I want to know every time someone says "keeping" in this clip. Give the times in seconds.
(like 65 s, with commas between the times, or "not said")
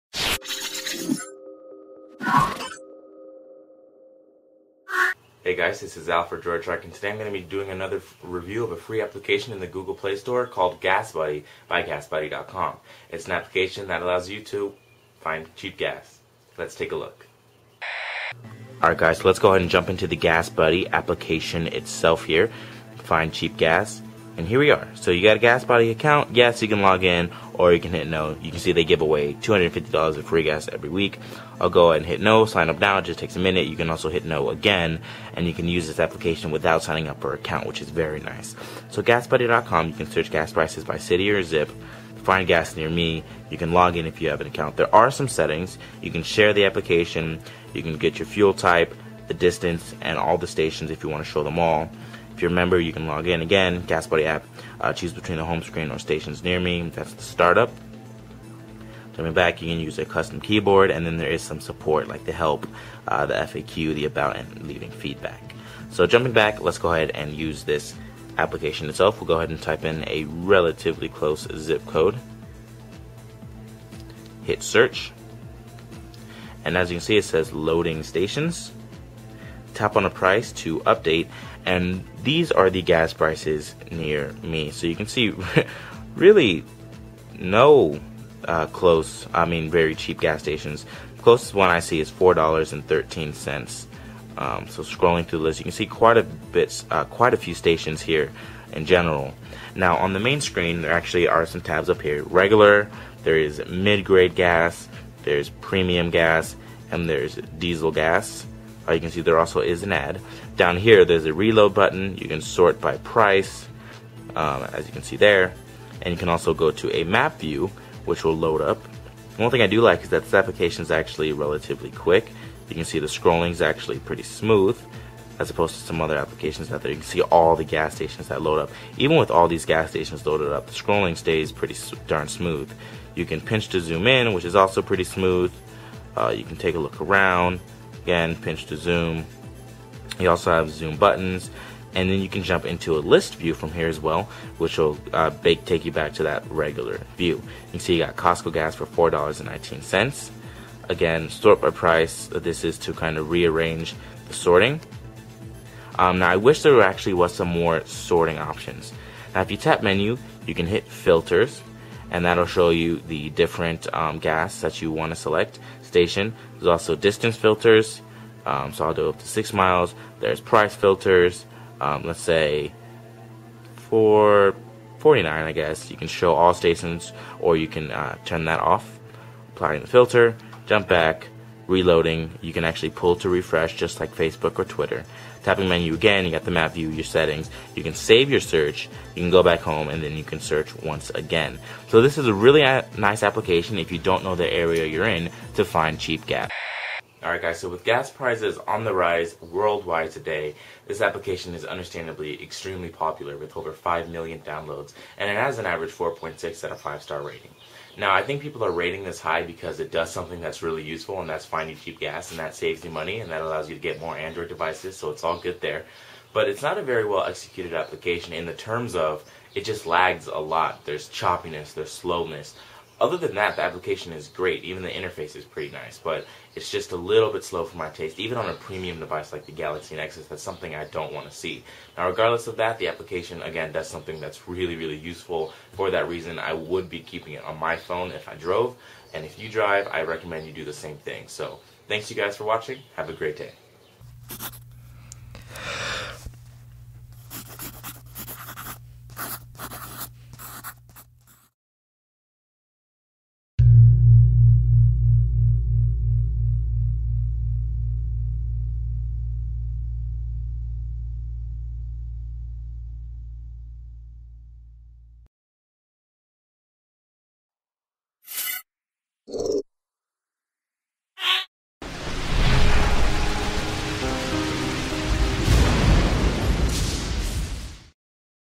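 236 s.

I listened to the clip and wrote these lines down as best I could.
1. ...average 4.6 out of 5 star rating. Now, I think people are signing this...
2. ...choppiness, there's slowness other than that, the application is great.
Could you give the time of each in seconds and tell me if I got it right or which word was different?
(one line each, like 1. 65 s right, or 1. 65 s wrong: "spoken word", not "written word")
1. 205 s wrong: "rating", not "signing"
2. 221 s right.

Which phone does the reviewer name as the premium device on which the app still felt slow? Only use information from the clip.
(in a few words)
Galaxy Nexus.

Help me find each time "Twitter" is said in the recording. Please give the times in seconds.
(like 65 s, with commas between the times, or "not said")
184 s.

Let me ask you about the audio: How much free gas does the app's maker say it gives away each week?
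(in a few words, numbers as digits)
$250.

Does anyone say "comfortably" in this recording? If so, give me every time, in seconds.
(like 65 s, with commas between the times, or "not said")
not said.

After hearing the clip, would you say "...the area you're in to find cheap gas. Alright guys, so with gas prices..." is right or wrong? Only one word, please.
right.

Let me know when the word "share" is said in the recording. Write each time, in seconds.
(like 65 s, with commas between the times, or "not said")
46 s.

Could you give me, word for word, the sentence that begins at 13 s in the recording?
It's an application that allows you to find cheap gas.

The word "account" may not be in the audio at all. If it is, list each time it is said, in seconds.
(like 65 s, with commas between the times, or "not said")
25 s, 37 s, 44 s.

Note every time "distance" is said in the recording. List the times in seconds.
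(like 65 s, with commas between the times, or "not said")
49 s, 166 s.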